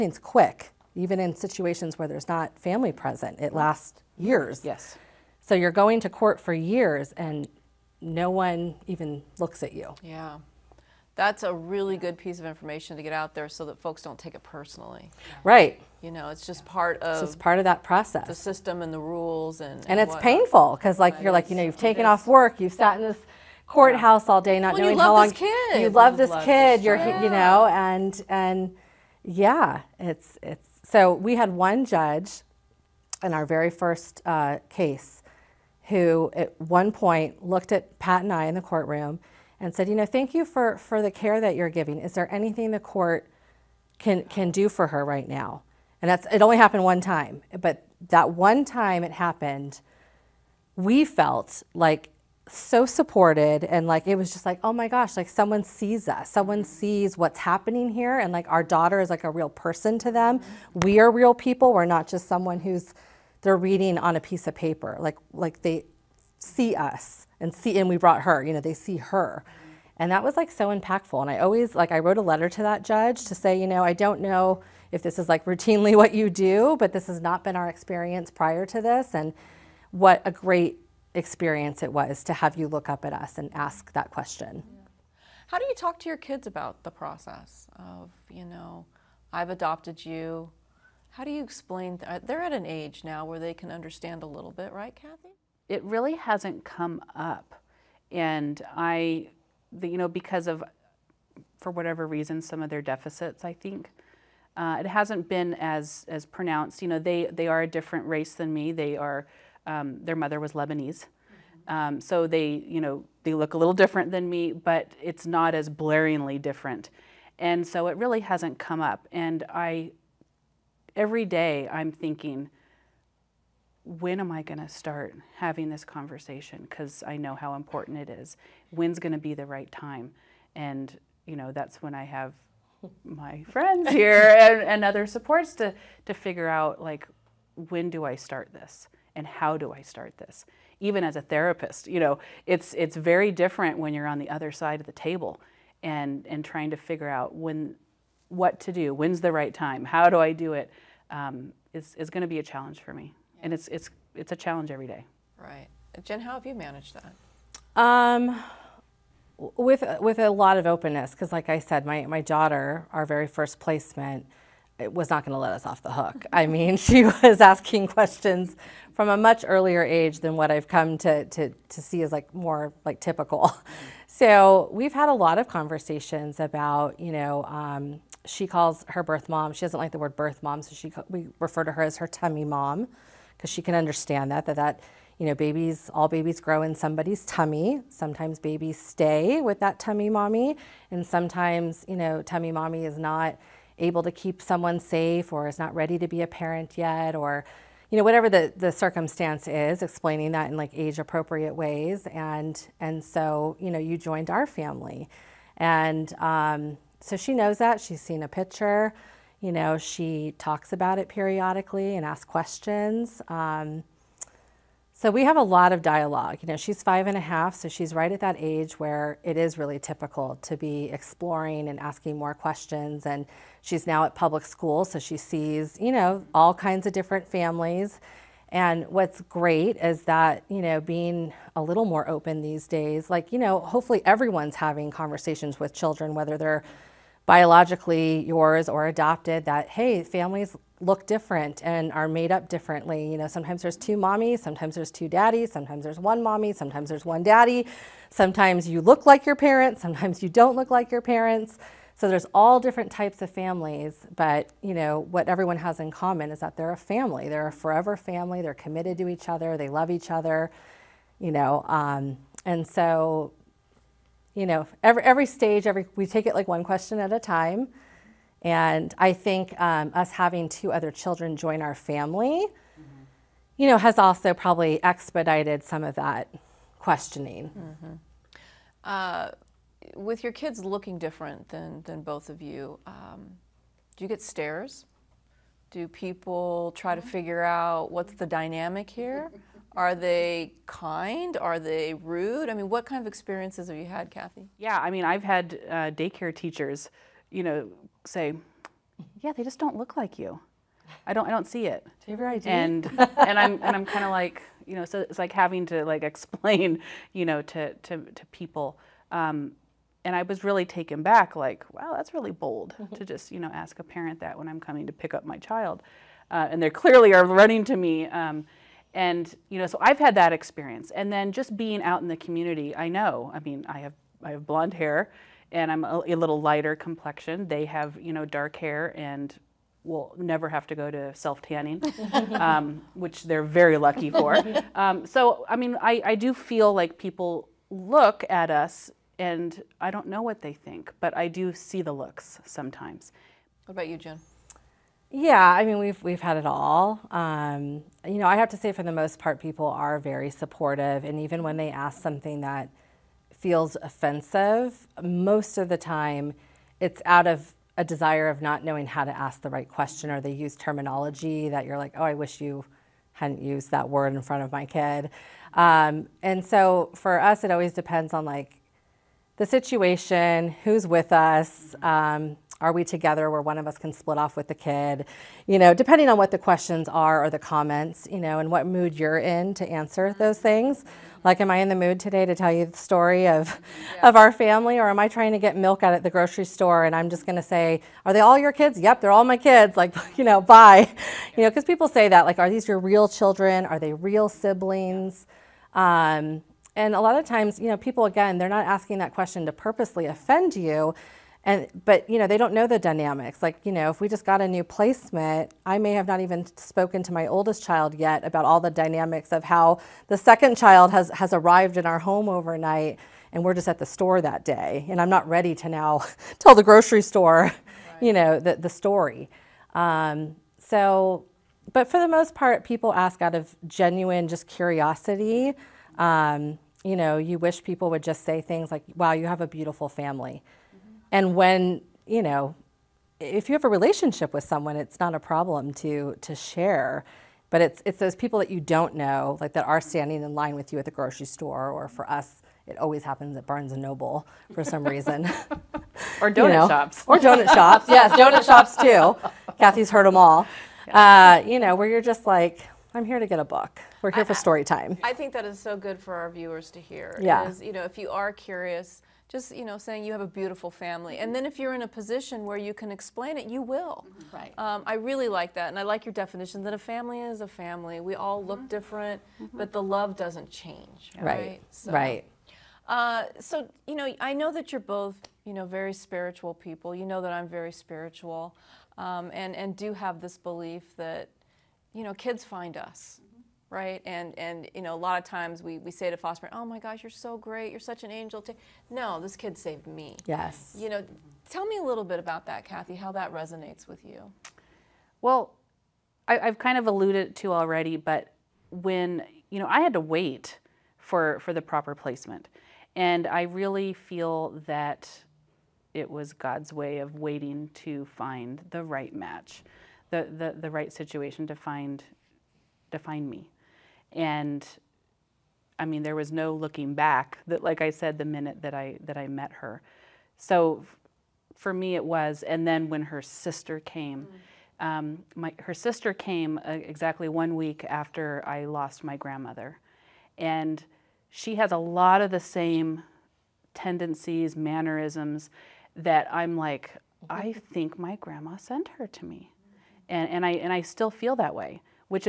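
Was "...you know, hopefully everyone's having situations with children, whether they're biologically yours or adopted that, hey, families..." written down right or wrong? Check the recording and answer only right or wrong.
wrong.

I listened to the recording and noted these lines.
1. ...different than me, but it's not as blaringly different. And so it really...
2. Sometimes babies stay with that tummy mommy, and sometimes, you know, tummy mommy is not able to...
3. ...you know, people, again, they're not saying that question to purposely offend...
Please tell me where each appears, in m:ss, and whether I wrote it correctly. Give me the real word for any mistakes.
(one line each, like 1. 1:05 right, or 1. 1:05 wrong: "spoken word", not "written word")
1. 1:53 right
2. 3:07 right
3. 6:37 wrong: "asking", not "saying".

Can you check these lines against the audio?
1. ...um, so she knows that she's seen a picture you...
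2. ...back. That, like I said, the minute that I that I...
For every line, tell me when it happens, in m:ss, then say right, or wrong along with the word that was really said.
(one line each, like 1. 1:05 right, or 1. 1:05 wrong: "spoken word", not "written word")
1. 3:26 right
2. 8:36 right.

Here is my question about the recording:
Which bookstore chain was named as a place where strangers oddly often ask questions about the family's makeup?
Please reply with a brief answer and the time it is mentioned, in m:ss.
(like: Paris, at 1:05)
Barnes and Noble, at 7:23.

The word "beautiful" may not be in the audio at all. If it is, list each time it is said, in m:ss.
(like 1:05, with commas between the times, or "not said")
7:09, 7:40.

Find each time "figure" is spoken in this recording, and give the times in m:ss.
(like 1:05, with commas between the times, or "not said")
2:16, 2:26, 4:47.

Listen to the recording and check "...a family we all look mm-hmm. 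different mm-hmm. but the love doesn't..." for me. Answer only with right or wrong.
right.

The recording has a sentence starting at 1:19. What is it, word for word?
And what a great experience it was to have you look up at us and ask that question.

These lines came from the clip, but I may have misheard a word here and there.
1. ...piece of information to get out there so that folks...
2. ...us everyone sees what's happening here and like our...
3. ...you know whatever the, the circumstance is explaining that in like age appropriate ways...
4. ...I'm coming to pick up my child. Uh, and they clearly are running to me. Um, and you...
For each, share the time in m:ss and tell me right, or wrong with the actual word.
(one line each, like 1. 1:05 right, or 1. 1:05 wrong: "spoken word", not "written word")
1. 0:12 right
2. 0:56 wrong: "someone", not "everyone"
3. 3:17 right
4. 5:14 right.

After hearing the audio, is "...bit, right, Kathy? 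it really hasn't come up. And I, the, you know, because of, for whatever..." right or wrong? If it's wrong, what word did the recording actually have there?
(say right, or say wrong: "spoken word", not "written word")
right.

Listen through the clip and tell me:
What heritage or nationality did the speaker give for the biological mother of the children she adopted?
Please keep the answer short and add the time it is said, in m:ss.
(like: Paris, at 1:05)
Lebanese, at 1:50.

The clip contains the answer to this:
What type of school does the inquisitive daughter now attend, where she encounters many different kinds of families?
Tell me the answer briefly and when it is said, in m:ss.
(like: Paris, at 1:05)
Public school, at 3:44.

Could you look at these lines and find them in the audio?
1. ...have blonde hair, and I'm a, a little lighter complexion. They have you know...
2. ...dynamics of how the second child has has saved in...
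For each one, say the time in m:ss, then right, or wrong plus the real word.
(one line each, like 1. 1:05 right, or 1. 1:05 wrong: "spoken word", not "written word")
1. 5:24 right
2. 6:48 wrong: "arrived", not "saved".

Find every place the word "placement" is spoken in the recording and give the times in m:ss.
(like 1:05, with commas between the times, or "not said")
2:43, 6:44, 8:21.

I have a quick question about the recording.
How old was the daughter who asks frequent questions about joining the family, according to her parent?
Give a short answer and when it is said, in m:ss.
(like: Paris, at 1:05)
5 and a half, at 3:36.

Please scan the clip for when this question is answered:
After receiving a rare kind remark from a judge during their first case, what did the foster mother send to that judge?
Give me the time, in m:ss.
1:11.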